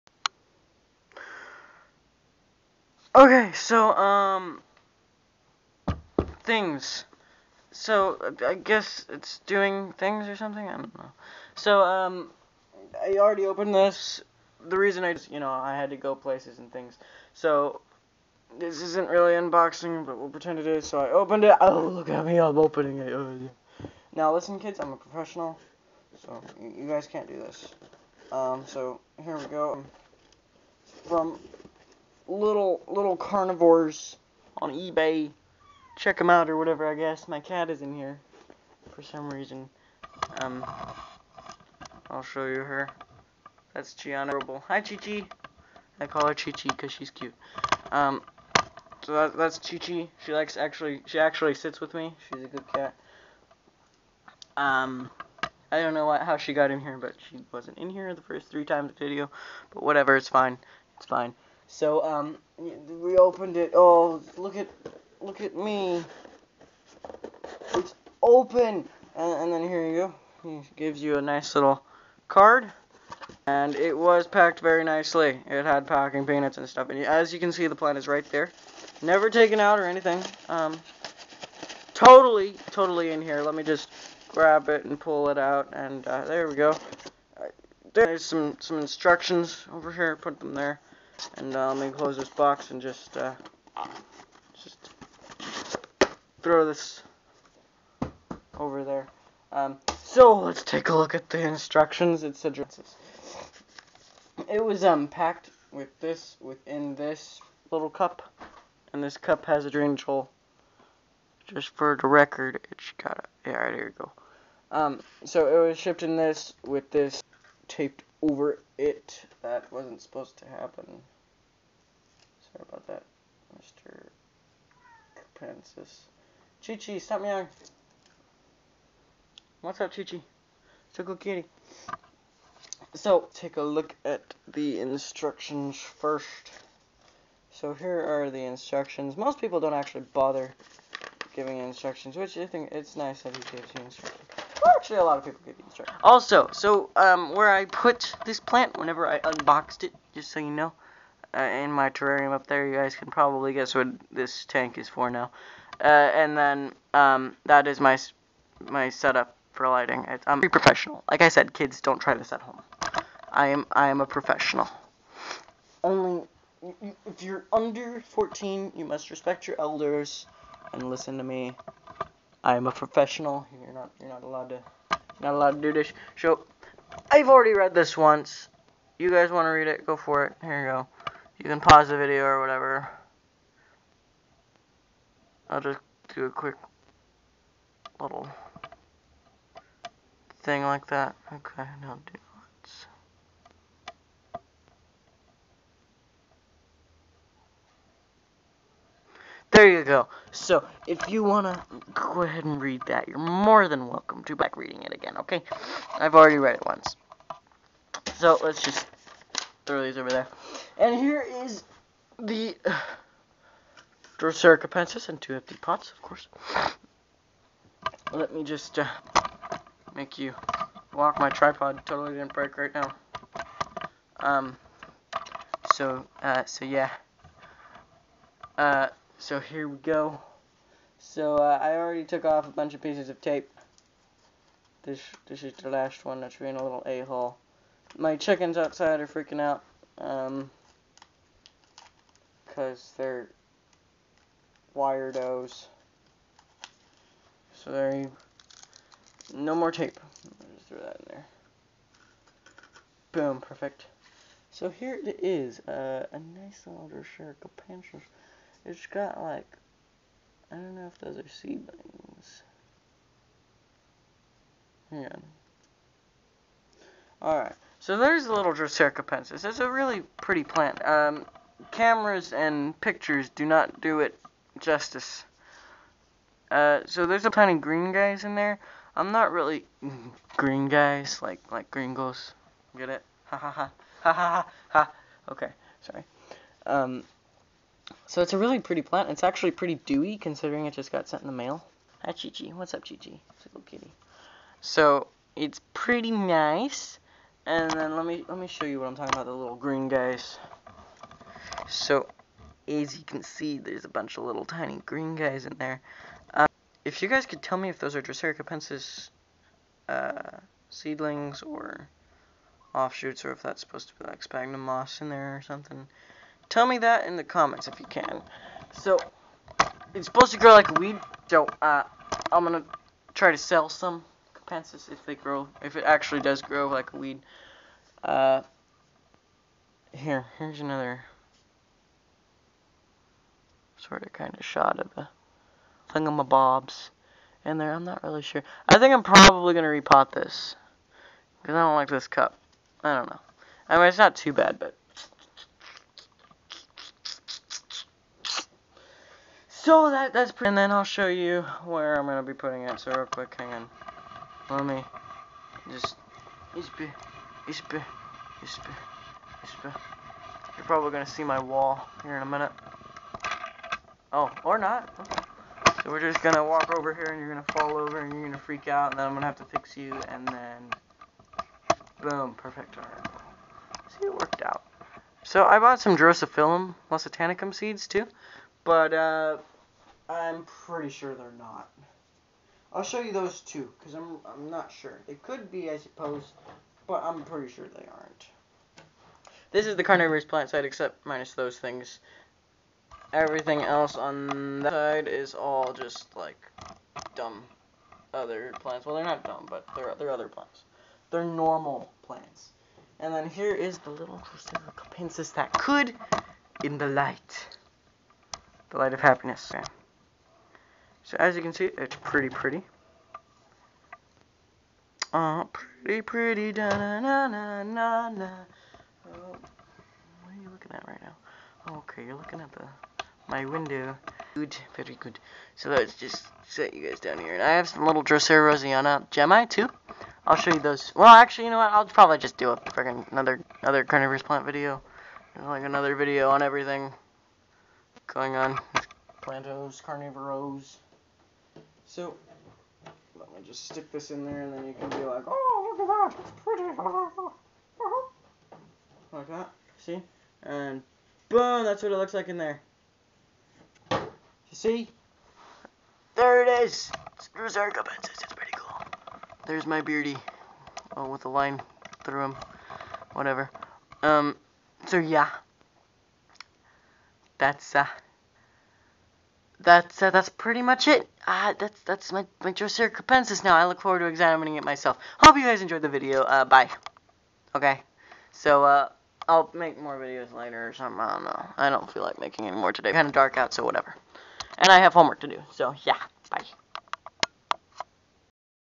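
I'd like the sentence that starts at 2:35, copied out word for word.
Uh, and then um, that is my my setup for lighting.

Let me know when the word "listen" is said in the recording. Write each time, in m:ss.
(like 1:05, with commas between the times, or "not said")
0:24, 2:50.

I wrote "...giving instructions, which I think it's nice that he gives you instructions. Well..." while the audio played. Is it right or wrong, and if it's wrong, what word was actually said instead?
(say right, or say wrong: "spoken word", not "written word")
right.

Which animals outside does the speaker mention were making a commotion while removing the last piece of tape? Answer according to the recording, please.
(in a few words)
Chickens.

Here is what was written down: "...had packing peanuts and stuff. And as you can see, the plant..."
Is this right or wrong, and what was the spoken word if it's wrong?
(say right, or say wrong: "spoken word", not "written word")
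right.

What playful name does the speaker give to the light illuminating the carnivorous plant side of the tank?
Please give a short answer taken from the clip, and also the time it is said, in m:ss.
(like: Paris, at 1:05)
The Light of Happiness, at 6:48.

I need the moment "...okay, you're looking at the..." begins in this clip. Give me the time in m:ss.
7:01.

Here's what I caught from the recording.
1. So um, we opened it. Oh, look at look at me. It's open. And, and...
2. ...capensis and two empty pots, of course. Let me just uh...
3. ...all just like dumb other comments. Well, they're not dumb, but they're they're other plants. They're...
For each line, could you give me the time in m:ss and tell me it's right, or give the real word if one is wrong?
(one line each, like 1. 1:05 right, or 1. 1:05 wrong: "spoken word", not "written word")
1. 1:01 right
2. 3:34 right
3. 6:35 wrong: "plants", not "comments".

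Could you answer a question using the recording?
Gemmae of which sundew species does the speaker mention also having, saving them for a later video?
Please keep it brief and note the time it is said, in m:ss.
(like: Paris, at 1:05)
Drosera roseana, at 7:08.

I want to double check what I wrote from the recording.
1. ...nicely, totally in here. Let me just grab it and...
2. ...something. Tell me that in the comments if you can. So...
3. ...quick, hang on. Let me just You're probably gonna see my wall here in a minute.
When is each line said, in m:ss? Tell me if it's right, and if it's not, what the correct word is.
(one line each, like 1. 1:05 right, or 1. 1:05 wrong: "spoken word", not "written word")
1. 1:21 wrong: "totally", not "nicely"
2. 5:15 right
3. 5:53 right.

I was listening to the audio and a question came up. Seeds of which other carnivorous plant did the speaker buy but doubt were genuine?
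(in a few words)
Drosophyllum lusitanicum.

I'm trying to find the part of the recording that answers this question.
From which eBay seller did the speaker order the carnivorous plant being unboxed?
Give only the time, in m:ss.
0:33.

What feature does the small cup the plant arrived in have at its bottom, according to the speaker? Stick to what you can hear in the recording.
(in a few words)
A drainage hole.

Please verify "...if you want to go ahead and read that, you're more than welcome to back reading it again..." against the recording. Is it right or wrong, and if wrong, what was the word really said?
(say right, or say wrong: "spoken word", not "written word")
right.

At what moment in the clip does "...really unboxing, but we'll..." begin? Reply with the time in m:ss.
0:19.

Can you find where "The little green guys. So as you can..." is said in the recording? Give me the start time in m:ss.
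4:59.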